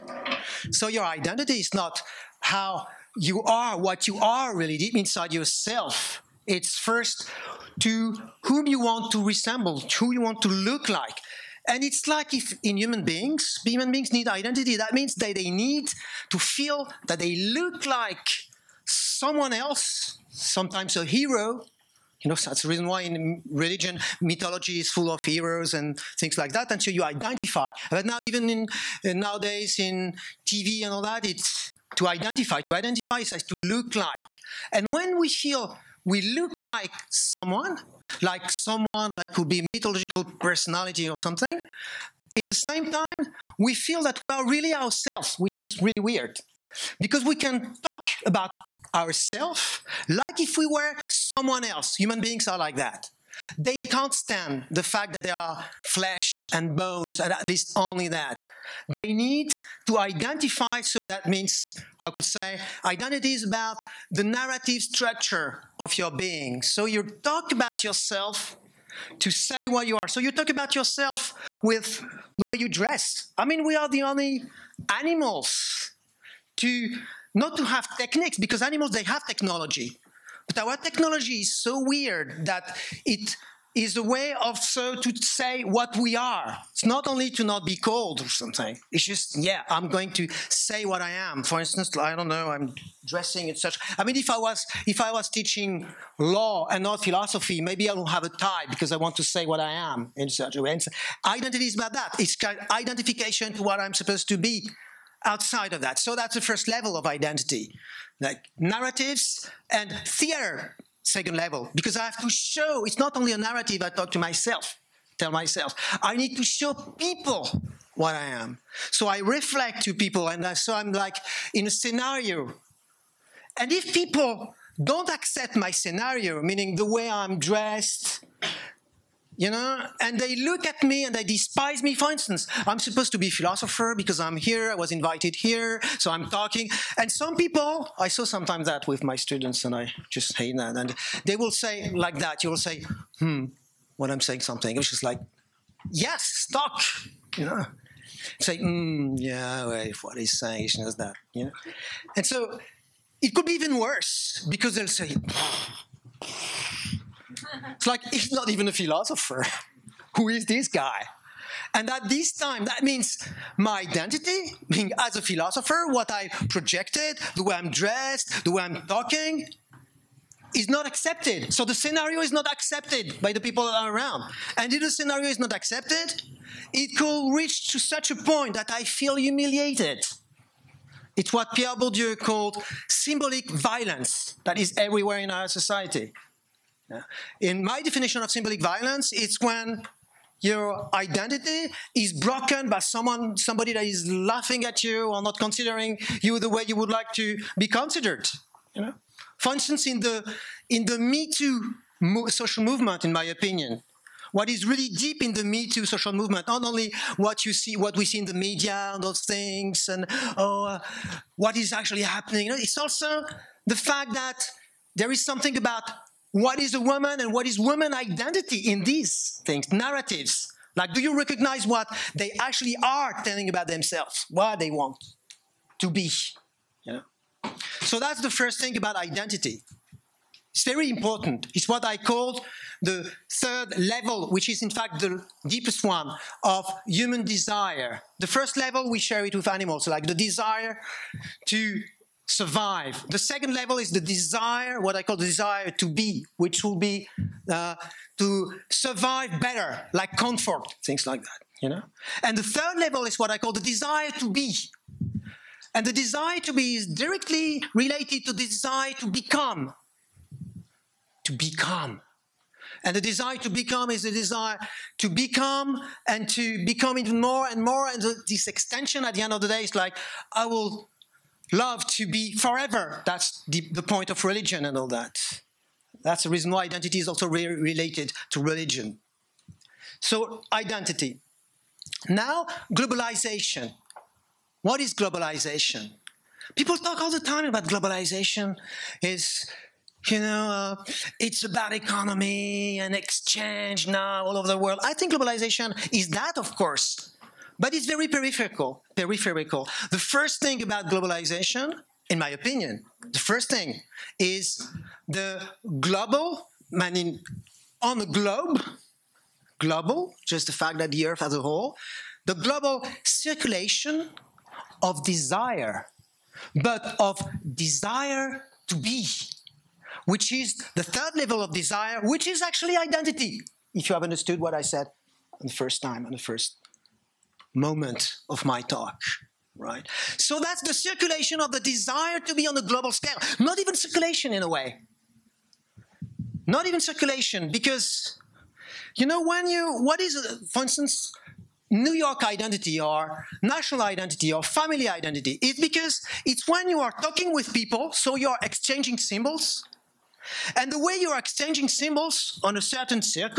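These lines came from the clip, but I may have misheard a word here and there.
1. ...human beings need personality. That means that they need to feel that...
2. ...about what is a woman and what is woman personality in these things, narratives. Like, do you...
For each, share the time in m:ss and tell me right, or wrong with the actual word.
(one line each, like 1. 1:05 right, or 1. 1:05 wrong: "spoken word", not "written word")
1. 0:13 wrong: "identity", not "personality"
2. 3:35 wrong: "identity", not "personality".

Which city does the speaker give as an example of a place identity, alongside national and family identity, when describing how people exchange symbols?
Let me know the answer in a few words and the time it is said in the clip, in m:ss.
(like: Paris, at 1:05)
New York, at 5:41.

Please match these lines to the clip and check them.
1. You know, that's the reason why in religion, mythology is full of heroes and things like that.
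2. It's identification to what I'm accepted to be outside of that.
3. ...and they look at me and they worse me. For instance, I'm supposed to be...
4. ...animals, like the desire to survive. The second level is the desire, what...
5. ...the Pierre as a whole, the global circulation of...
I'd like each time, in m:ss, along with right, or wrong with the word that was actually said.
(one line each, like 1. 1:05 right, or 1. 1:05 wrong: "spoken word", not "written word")
1. 0:22 right
2. 1:42 wrong: "supposed", not "accepted"
3. 2:10 wrong: "despise", not "worse"
4. 3:59 right
5. 5:10 wrong: "Earth", not "Pierre".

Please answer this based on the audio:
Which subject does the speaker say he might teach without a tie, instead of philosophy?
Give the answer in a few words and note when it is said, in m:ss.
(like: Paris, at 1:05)
law, at 1:36.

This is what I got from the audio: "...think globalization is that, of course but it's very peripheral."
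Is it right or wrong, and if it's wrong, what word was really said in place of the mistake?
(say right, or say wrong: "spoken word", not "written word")
right.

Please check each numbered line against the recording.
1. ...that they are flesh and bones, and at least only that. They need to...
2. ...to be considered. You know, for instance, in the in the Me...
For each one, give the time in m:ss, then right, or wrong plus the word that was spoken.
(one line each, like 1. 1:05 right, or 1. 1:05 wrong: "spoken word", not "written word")
1. 0:55 right
2. 3:17 right.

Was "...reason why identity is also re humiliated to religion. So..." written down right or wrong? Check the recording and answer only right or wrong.
wrong.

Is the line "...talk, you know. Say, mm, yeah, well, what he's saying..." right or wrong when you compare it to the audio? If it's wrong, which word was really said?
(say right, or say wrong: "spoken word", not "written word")
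right.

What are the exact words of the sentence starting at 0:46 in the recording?
Because we can talk about ourselves like if we were someone else.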